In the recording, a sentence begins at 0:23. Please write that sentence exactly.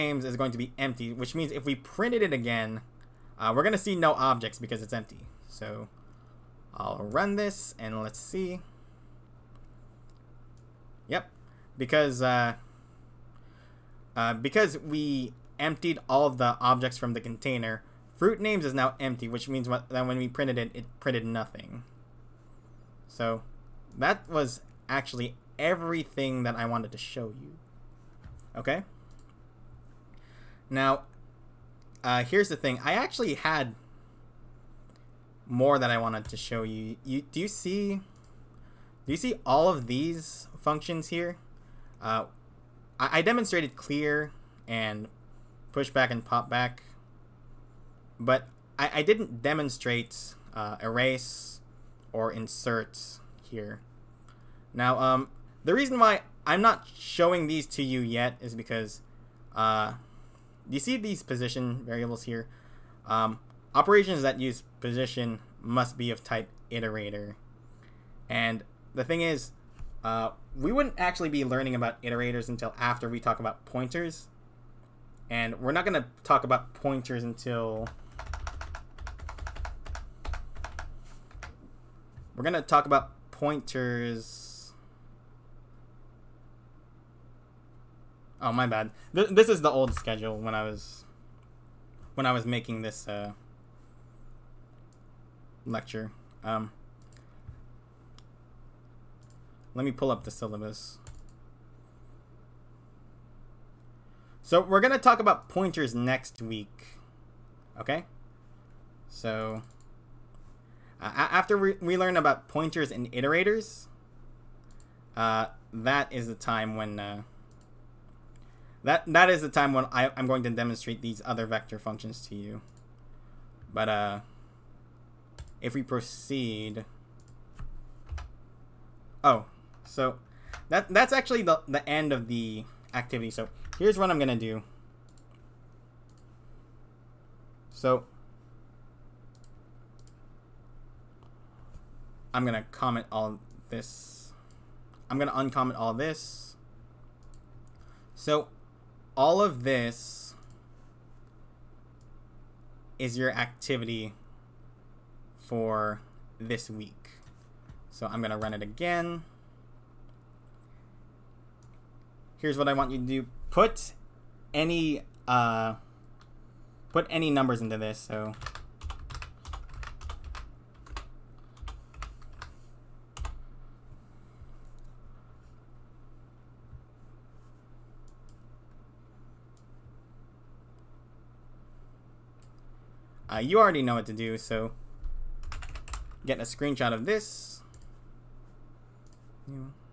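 So that was actually everything that I wanted to show you.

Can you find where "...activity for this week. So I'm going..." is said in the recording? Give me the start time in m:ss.
2:33.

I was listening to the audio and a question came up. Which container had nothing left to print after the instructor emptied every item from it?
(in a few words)
fruit names.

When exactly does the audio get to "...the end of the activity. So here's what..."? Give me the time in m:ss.
2:11.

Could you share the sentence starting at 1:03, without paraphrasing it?
Um, operations that use position must be of type iterator.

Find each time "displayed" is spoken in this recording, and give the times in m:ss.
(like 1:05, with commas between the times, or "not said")
not said.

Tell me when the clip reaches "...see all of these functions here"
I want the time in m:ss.
0:39.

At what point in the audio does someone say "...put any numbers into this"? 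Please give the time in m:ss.
2:46.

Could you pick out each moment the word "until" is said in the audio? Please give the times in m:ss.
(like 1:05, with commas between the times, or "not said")
1:12, 1:17.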